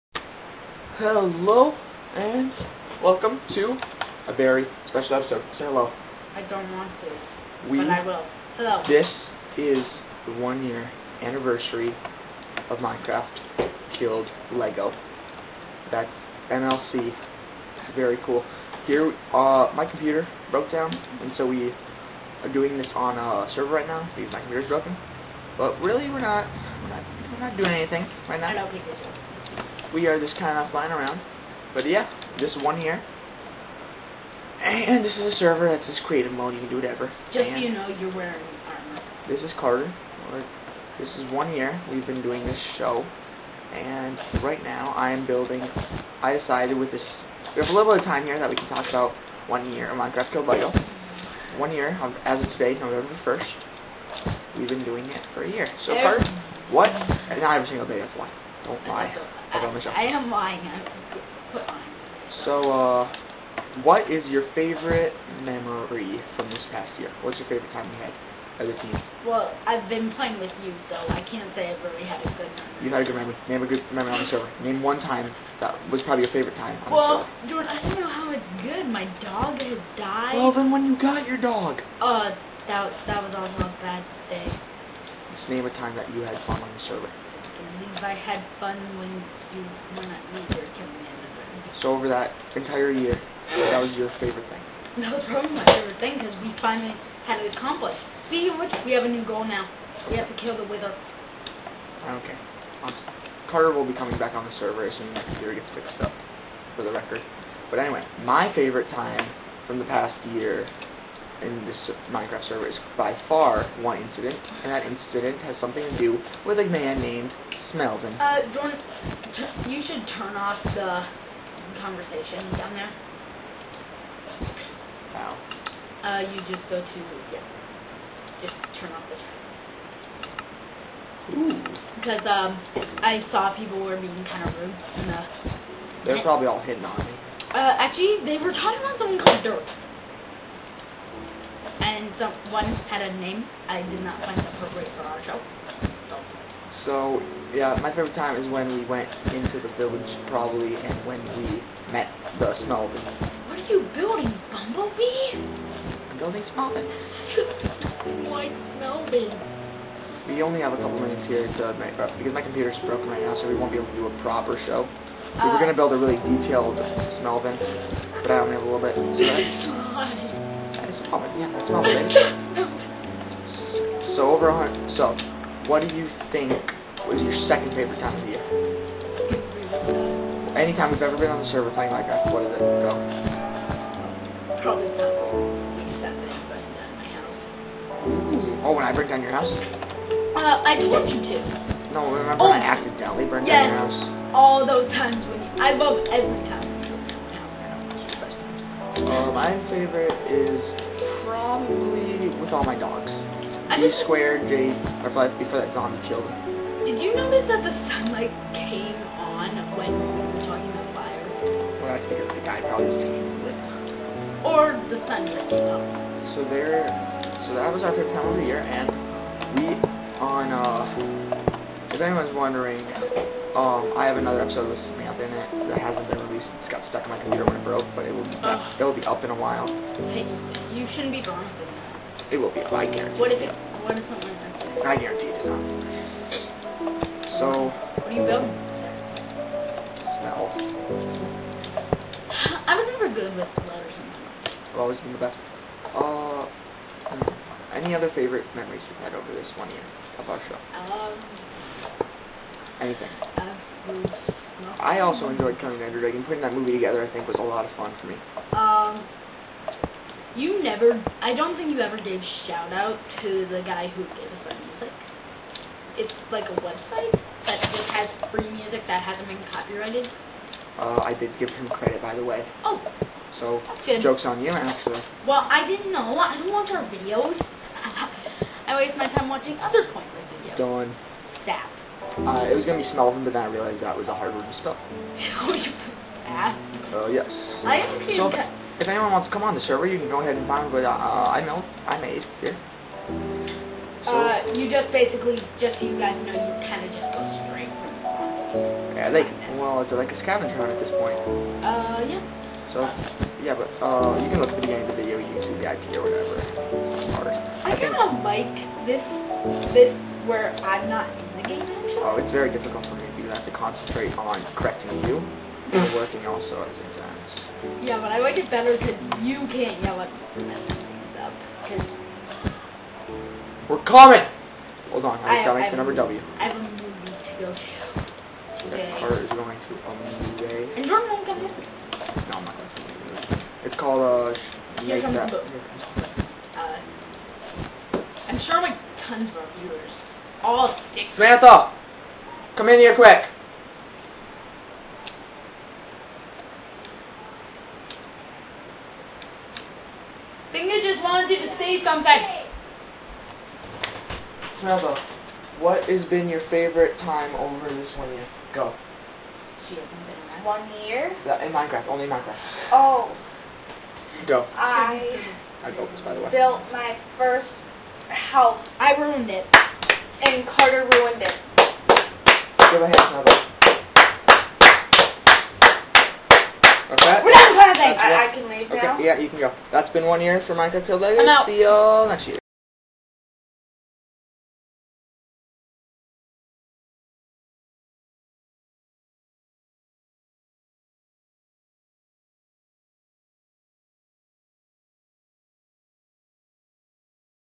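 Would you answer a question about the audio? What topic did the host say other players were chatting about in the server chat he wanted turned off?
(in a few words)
dirt.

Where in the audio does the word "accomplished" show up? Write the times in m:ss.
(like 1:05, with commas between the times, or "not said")
1:37.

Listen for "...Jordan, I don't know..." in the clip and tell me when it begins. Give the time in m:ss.
1:17.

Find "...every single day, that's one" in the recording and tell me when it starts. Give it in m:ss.
0:57.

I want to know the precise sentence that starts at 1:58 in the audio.
Uh, Jordan, you should turn off the conversation down there.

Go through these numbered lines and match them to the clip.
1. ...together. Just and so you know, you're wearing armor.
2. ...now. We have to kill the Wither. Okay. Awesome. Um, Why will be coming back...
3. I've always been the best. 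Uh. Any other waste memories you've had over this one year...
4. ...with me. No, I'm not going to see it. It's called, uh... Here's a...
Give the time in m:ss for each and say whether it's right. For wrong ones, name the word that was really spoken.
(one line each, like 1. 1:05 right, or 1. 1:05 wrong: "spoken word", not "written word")
1. 0:36 wrong: "whatever", not "together"
2. 1:39 wrong: "Carter", not "Why"
3. 4:04 wrong: "favorite", not "waste"
4. 5:31 right.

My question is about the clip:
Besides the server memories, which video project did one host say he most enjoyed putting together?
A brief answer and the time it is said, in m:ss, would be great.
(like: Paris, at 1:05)
Coming Ender Dragon, at 4:15.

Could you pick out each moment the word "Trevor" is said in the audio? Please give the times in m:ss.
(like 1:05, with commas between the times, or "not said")
5:54, 6:13.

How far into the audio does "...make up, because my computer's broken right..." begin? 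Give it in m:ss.
2:41.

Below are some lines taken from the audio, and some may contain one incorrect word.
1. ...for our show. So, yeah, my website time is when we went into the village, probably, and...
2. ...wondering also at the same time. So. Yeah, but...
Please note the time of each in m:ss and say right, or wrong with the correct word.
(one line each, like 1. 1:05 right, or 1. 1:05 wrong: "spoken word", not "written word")
1. 2:24 wrong: "favorite", not "website"
2. 5:15 wrong: "working", not "wondering".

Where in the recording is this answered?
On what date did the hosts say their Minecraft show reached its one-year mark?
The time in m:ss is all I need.
0:52.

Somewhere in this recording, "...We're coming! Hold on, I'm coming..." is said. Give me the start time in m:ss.
5:23.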